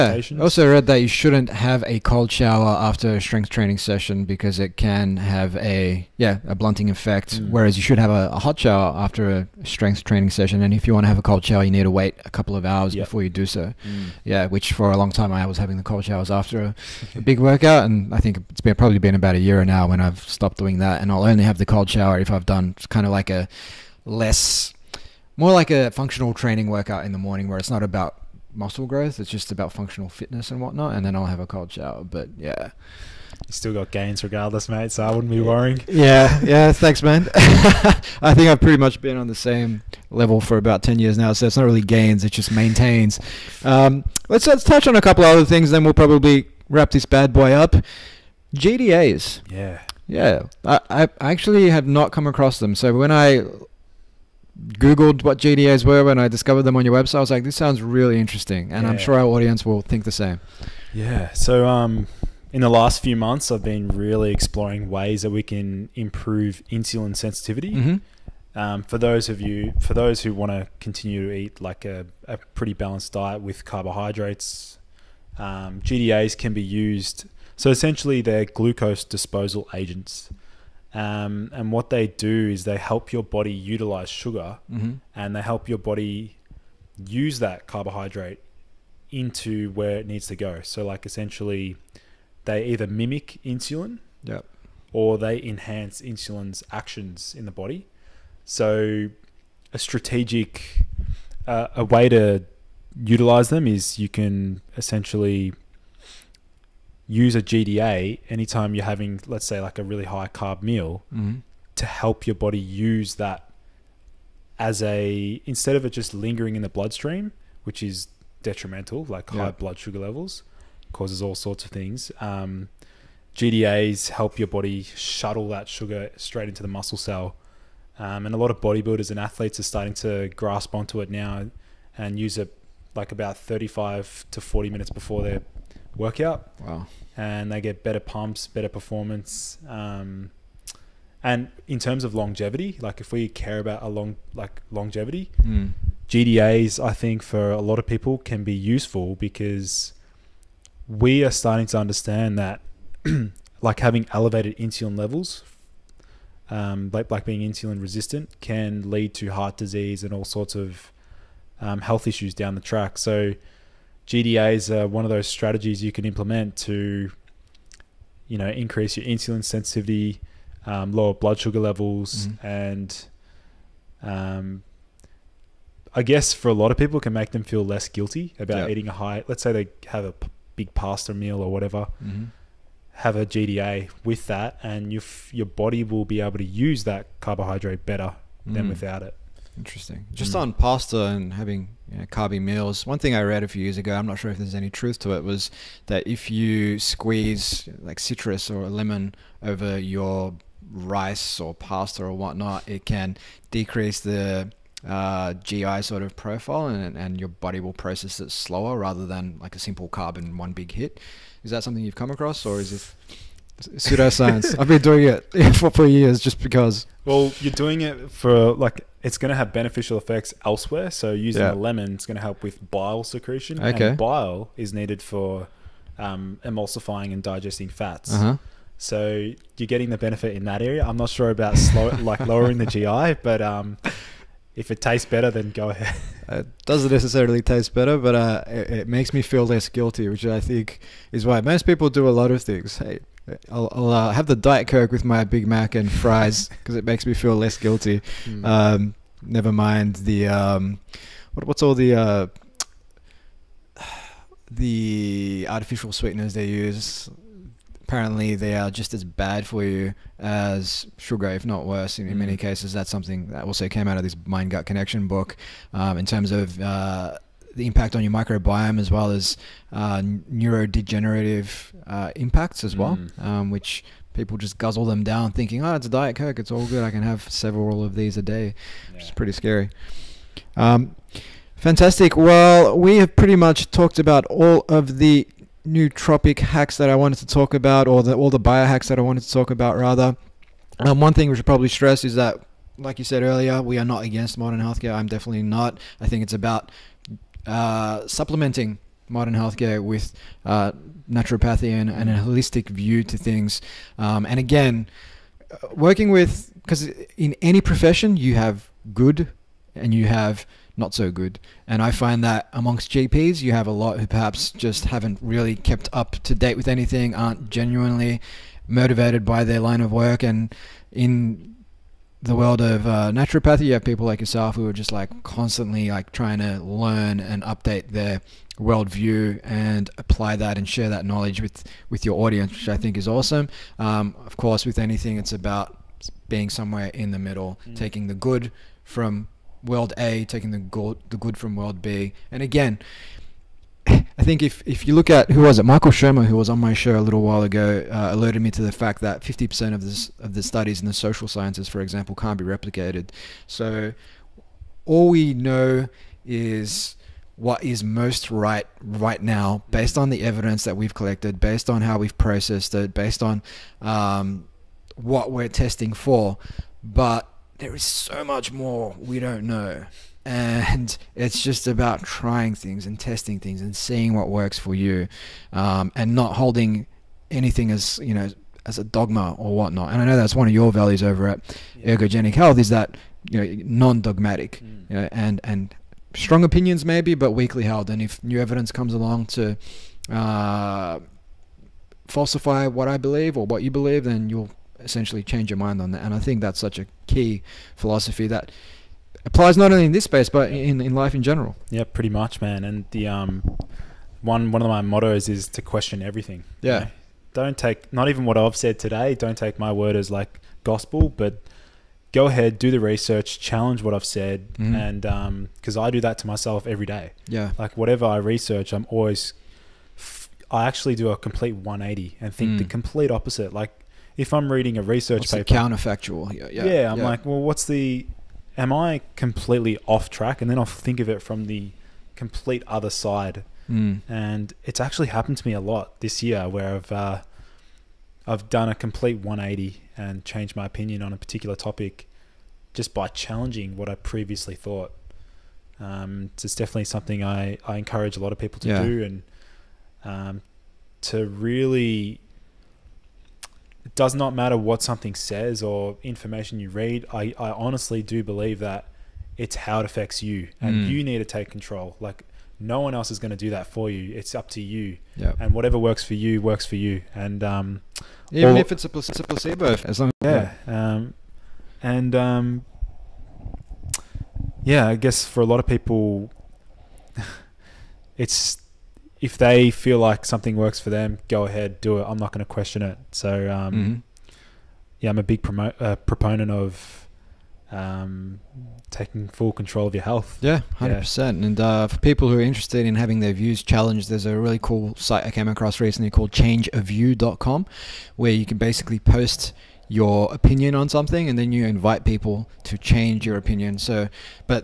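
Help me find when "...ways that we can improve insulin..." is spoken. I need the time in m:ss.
1:04.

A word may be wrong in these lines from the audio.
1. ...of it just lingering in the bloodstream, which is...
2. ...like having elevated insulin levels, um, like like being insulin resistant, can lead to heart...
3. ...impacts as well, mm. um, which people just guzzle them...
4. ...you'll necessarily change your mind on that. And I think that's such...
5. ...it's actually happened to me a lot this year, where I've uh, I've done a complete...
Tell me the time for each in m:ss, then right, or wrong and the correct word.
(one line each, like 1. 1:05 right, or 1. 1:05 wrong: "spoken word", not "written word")
1. 1:55 right
2. 2:33 right
3. 4:32 right
4. 6:34 wrong: "essentially", not "necessarily"
5. 7:14 right.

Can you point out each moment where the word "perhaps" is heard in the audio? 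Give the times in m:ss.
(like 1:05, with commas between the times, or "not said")
5:14.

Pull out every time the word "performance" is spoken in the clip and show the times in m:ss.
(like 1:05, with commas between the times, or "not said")
2:18.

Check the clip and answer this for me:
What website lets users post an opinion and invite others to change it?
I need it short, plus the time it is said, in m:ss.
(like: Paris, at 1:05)
changeaview.com, at 8:16.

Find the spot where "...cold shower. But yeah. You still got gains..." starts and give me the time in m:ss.
0:31.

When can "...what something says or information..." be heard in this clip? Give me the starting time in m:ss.
7:34.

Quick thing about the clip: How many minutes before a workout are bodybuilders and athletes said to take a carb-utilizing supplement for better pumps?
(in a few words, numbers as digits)
35 to 40.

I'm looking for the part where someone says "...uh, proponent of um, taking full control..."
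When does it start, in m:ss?
8:05.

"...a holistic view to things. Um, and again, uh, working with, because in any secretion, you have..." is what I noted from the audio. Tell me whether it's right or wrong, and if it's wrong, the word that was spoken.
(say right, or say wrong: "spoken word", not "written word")
wrong: "profession", not "secretion".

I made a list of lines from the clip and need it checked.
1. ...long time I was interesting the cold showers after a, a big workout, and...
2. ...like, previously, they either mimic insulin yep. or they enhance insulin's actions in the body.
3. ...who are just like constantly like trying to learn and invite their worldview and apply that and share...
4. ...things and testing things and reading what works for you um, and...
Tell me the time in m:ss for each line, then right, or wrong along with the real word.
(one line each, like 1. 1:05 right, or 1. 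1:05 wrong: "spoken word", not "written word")
1. 0:14 wrong: "having", not "interesting"
2. 1:30 wrong: "essentially", not "previously"
3. 5:24 wrong: "update", not "invite"
4. 6:12 wrong: "seeing", not "reading".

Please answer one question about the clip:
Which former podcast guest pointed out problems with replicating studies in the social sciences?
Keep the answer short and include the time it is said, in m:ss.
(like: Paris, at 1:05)
Michael Shermer, at 5:45.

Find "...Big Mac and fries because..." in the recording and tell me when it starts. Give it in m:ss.
4:05.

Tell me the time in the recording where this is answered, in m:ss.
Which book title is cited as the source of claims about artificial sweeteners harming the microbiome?
4:24.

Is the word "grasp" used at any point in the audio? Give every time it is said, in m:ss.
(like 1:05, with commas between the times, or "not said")
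2:10.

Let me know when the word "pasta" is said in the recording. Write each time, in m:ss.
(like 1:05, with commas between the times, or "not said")
3:00, 3:10, 3:21.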